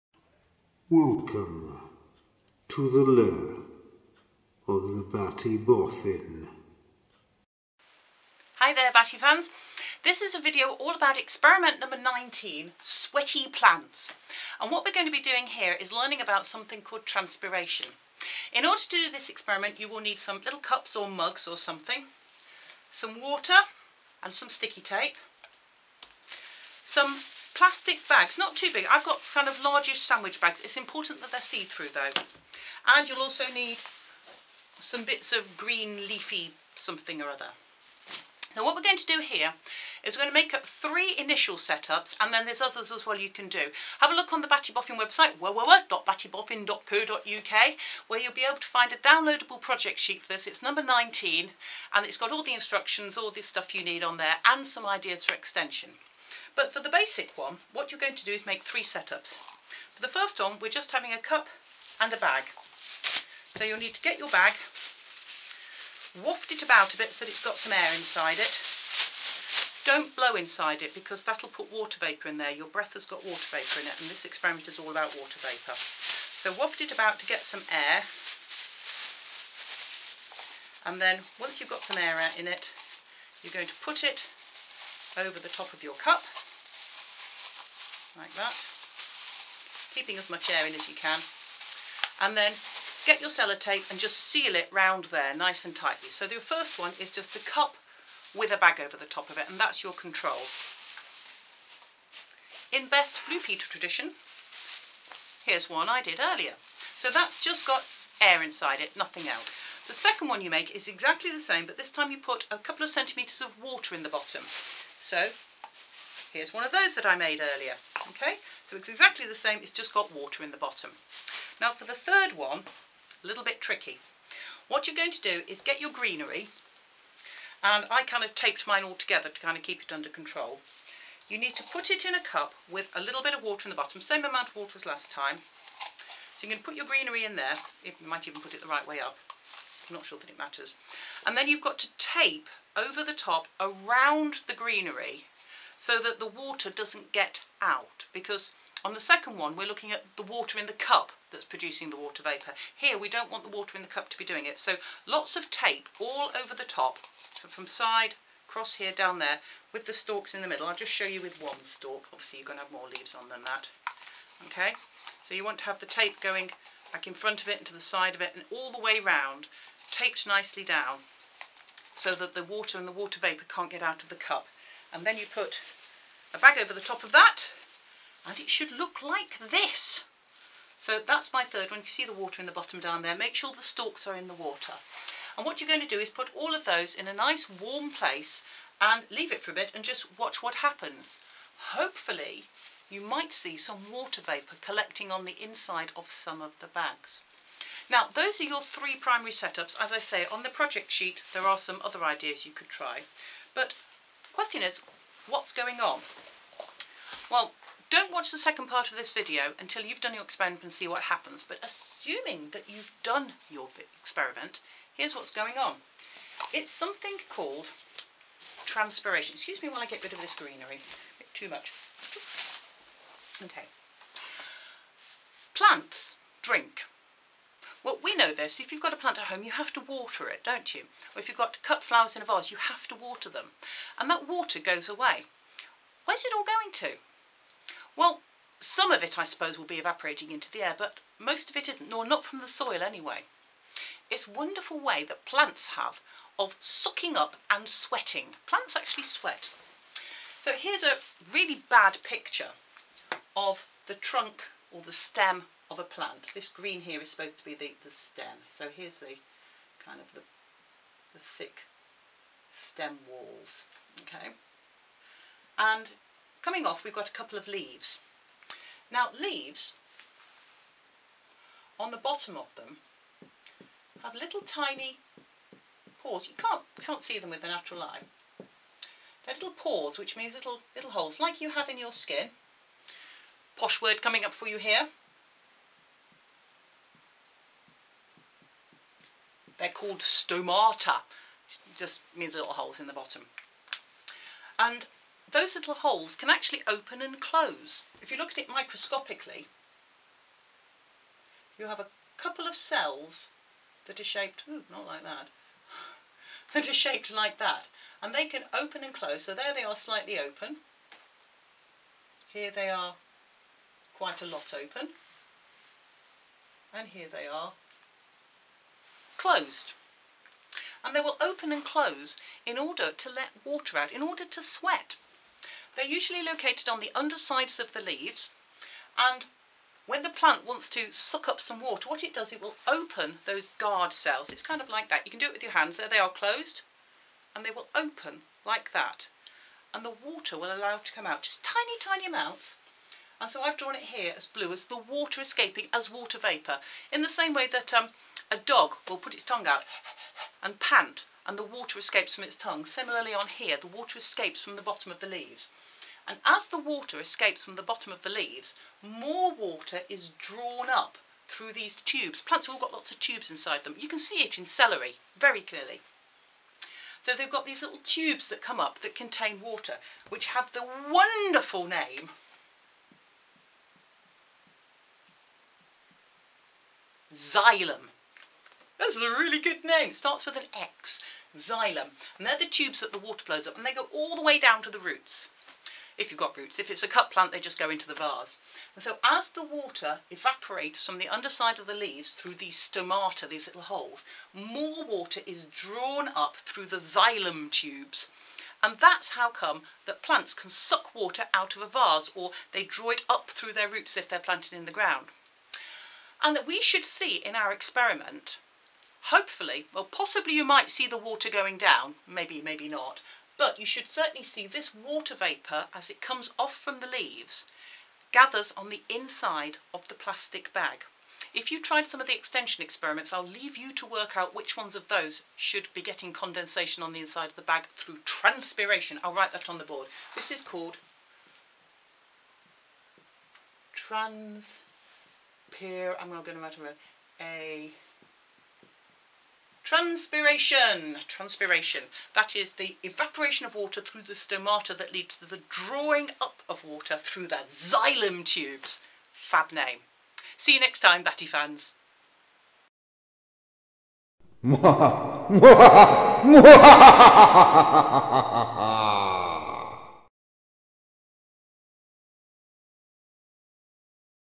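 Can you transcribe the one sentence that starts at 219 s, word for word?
Excuse me while I get rid of this greenery, a bit too much.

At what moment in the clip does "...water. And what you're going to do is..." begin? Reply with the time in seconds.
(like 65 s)
184 s.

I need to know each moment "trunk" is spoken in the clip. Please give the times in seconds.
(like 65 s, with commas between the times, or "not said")
253 s.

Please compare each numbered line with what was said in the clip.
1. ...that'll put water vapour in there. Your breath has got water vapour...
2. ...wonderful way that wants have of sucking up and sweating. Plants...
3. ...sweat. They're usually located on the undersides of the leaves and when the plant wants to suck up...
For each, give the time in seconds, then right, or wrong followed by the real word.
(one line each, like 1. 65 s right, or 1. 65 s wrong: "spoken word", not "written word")
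1. 71 s right
2. 244 s wrong: "plants", not "wants"
3. 324 s right.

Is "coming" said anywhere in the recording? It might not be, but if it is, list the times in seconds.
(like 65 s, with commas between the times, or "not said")
266 s, 284 s.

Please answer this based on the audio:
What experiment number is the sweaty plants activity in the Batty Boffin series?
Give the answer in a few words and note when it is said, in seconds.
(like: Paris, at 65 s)
19, at 11 s.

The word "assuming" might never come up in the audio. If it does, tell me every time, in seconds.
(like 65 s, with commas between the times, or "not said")
211 s.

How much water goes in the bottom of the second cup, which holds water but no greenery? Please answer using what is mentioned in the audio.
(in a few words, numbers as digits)
a couple of centimetres.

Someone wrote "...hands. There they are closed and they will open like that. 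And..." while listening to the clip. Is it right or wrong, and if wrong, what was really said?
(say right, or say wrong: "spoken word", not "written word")
right.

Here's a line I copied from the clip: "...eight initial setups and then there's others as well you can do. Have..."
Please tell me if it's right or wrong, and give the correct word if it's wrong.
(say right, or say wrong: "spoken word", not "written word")
wrong: "three", not "eight".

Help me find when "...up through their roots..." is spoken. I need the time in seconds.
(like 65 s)
403 s.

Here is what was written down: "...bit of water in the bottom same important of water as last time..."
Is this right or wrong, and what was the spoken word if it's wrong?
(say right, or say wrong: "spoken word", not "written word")
wrong: "amount", not "important".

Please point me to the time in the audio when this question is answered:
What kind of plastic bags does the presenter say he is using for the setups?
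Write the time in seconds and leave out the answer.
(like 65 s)
29 s.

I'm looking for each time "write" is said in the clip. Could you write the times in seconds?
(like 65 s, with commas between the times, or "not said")
429 s, 436 s.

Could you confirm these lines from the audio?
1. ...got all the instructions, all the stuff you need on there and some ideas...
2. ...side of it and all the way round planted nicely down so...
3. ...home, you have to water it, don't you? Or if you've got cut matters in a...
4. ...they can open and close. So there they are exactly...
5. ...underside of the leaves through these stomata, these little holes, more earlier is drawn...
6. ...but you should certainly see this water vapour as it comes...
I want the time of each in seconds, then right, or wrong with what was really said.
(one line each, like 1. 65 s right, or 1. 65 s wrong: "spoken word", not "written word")
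1. 52 s right
2. 167 s wrong: "taped", not "planted"
3. 229 s wrong: "flowers", not "matters"
4. 308 s wrong: "slightly", not "exactly"
5. 391 s wrong: "water", not "earlier"
6. 413 s right.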